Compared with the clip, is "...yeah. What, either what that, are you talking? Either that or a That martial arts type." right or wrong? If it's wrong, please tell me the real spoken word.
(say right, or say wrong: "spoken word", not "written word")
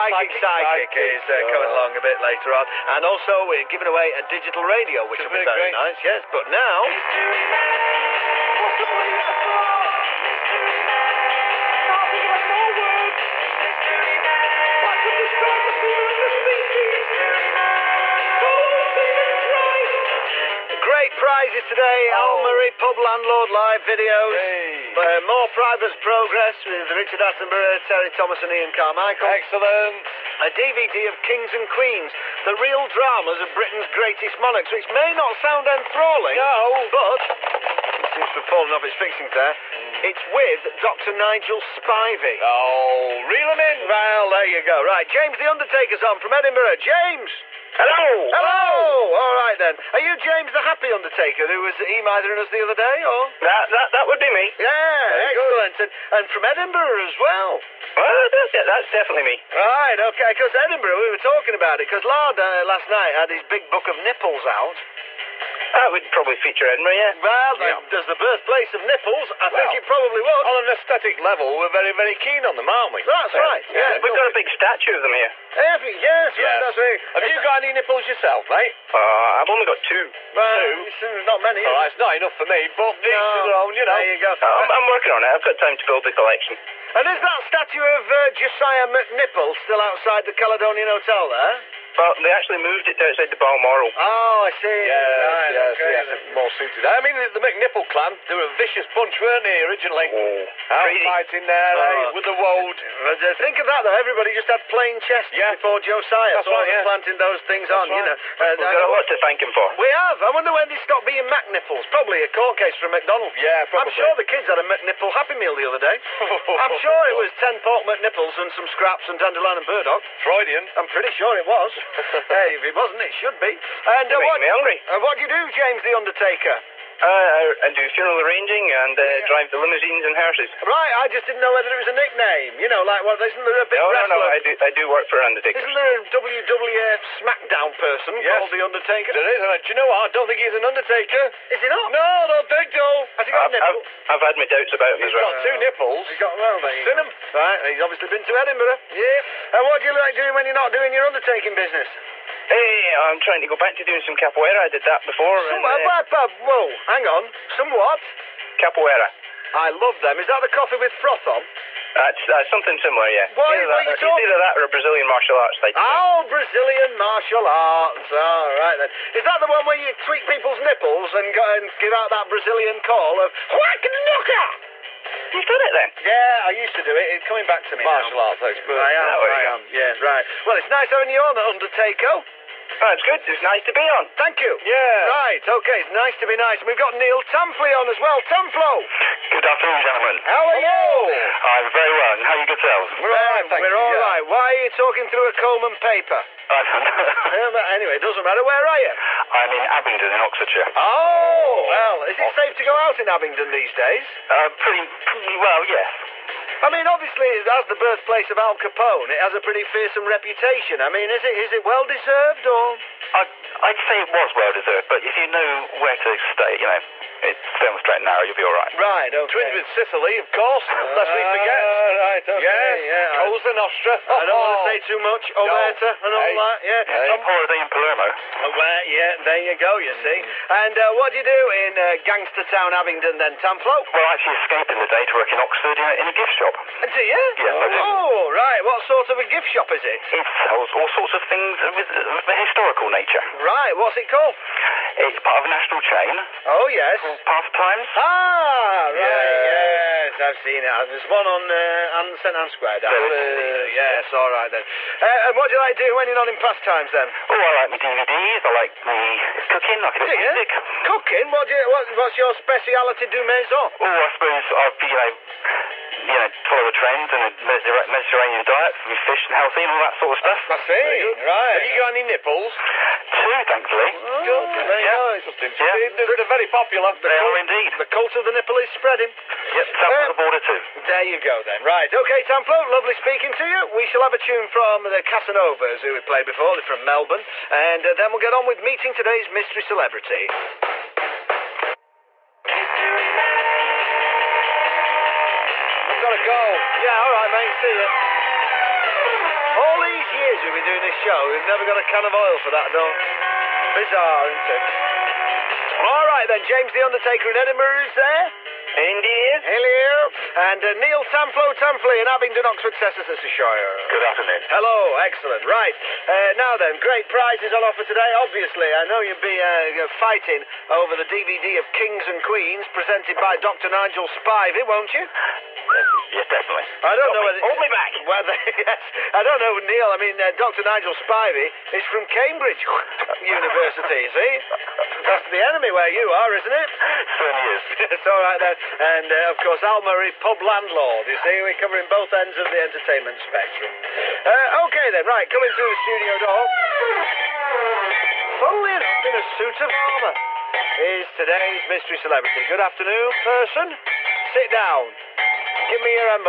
wrong: "Brazilian", not "That".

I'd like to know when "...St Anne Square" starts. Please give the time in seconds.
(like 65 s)
252 s.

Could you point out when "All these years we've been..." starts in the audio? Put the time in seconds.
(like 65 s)
299 s.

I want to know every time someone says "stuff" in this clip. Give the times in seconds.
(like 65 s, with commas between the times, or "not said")
270 s.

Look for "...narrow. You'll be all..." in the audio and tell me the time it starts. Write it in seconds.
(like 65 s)
218 s.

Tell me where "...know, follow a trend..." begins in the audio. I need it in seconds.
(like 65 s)
266 s.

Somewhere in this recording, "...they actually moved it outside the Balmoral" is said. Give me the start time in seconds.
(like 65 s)
92 s.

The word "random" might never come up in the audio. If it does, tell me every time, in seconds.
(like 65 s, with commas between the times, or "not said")
not said.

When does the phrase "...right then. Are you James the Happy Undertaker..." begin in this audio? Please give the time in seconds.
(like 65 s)
49 s.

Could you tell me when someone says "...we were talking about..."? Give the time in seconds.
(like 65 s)
61 s.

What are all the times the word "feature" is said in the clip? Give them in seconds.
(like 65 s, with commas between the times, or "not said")
66 s.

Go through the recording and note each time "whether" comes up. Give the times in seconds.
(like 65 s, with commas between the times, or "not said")
131 s, 327 s.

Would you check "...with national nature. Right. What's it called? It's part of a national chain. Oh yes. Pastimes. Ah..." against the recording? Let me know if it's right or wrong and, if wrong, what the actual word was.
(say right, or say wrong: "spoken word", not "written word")
wrong: "historical", not "national".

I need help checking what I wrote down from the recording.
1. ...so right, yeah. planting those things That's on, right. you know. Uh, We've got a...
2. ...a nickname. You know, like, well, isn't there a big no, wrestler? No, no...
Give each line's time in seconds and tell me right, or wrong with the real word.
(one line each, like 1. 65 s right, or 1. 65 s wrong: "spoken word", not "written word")
1. 106 s right
2. 131 s right.